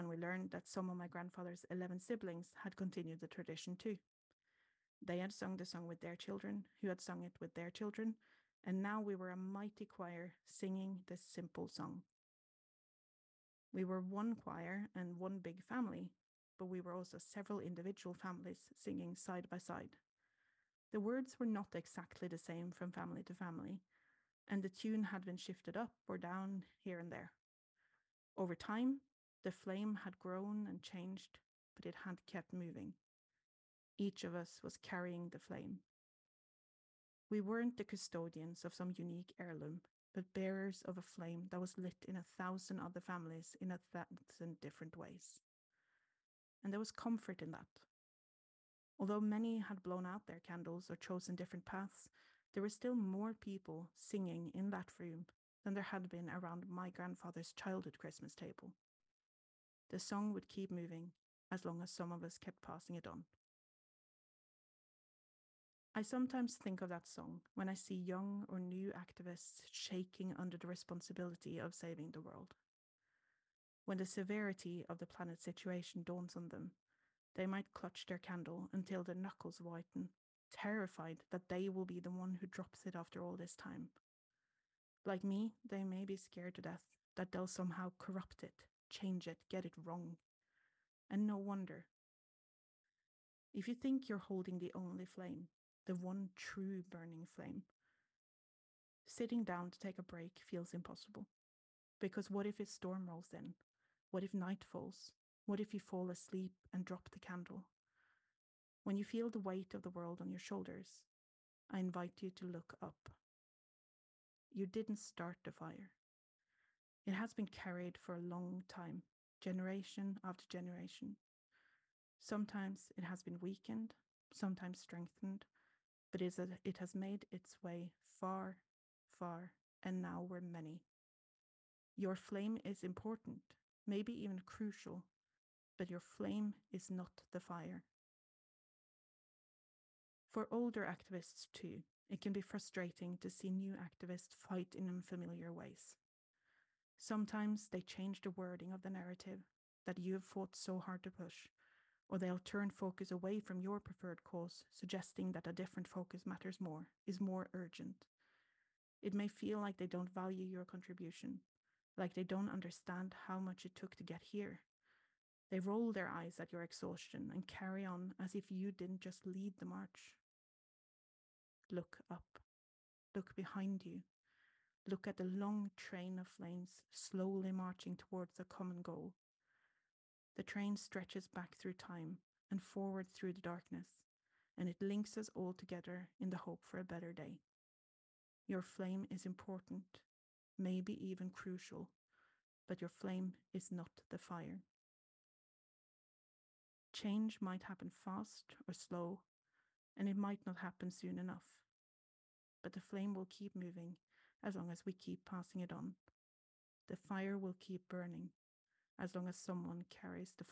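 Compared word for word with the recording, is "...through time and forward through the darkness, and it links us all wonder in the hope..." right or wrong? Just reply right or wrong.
wrong.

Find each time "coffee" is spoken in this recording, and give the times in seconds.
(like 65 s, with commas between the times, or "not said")
not said.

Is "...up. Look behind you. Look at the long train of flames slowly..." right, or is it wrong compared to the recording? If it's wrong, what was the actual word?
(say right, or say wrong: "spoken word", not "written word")
right.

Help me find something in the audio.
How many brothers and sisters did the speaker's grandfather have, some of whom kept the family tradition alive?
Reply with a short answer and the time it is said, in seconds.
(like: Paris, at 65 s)
11, at 1 s.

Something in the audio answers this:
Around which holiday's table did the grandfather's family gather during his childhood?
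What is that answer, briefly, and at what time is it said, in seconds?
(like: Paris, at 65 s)
Christmas, at 57 s.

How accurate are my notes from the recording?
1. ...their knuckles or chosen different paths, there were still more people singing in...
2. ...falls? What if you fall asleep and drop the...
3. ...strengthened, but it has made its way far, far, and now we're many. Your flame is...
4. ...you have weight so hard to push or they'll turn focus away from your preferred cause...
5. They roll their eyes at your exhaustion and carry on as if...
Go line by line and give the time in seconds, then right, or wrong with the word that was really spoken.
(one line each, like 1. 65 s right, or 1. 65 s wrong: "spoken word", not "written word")
1. 50 s wrong: "candles", not "knuckles"
2. 104 s right
3. 124 s right
4. 149 s wrong: "fought", not "weight"
5. 165 s right.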